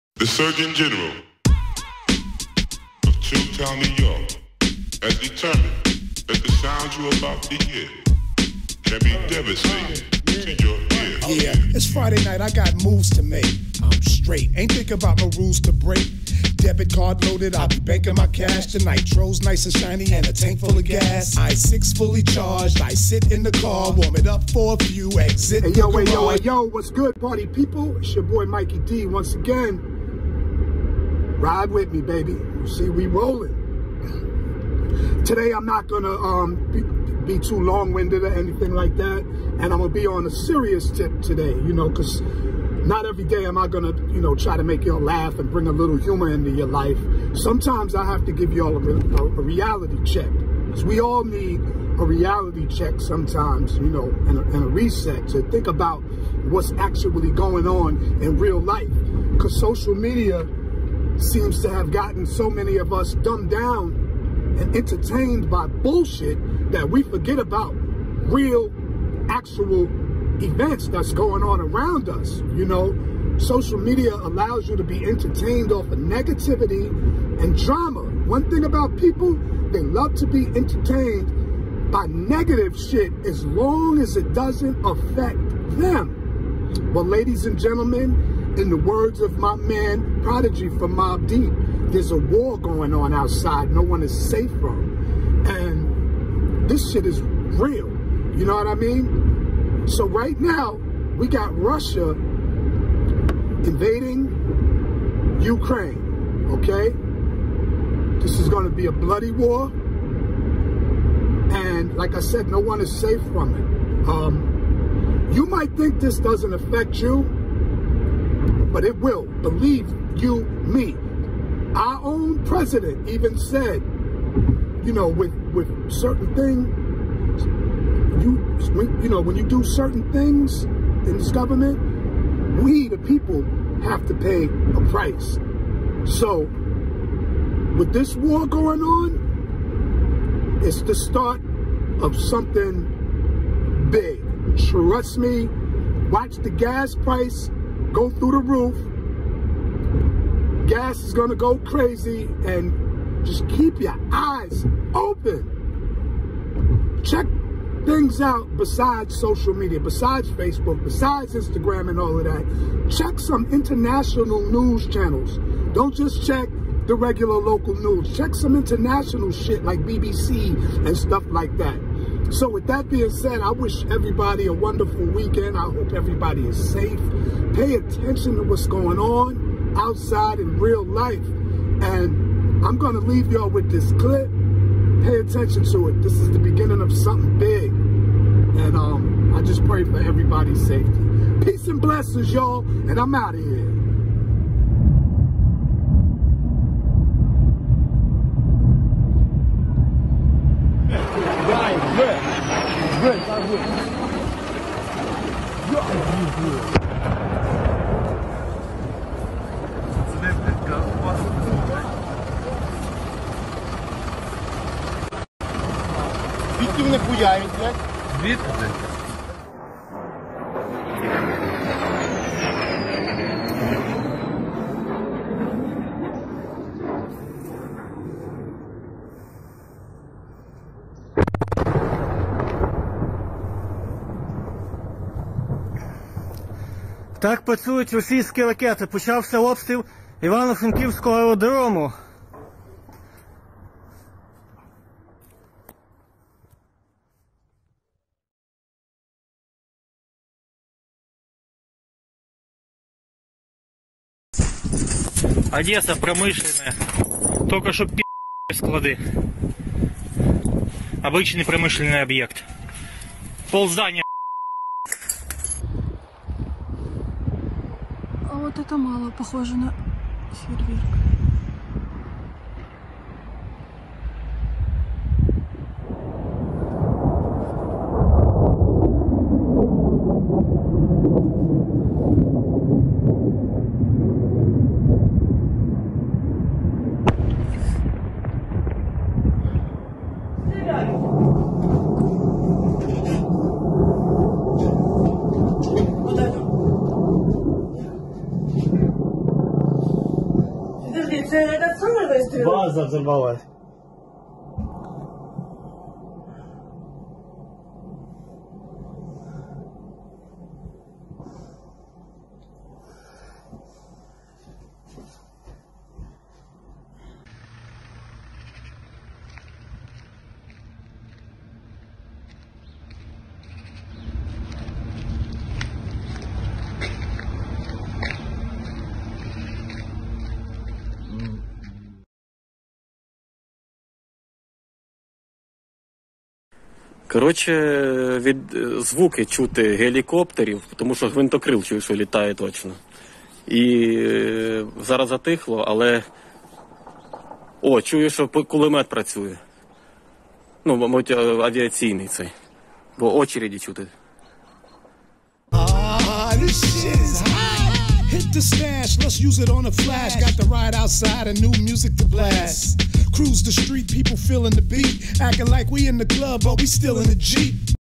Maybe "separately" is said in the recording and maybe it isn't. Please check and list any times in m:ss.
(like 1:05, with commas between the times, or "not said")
not said.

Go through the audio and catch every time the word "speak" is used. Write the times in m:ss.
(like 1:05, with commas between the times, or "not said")
not said.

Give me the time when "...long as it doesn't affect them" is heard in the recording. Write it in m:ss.
1:23.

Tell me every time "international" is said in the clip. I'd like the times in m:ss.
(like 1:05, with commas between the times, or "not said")
2:43, 2:48.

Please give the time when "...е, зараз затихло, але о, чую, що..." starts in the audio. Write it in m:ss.
5:43.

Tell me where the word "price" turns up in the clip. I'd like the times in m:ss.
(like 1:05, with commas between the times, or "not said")
2:14, 2:26.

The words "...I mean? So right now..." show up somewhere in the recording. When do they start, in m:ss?
1:38.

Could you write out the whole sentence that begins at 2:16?
So with this war going on, it's the start of something big.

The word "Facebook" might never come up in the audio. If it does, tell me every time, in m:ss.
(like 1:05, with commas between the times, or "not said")
2:40.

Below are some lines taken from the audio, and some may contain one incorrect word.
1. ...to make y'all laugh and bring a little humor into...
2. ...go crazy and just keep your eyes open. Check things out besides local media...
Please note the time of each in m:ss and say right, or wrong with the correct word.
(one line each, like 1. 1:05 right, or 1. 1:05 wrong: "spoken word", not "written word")
1. 0:44 right
2. 2:31 wrong: "social", not "local".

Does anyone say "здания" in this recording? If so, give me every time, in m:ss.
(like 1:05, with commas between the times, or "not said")
4:23.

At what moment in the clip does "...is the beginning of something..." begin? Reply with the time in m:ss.
3:06.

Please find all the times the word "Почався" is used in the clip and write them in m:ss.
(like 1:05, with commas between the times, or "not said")
3:58.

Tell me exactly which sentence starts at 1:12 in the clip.
You know, social media allows you to be entertained off of negativity and drama.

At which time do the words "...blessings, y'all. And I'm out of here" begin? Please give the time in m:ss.
3:11.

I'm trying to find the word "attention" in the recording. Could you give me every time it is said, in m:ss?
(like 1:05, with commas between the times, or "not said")
2:57, 3:05.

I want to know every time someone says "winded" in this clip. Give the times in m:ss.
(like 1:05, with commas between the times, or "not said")
0:37.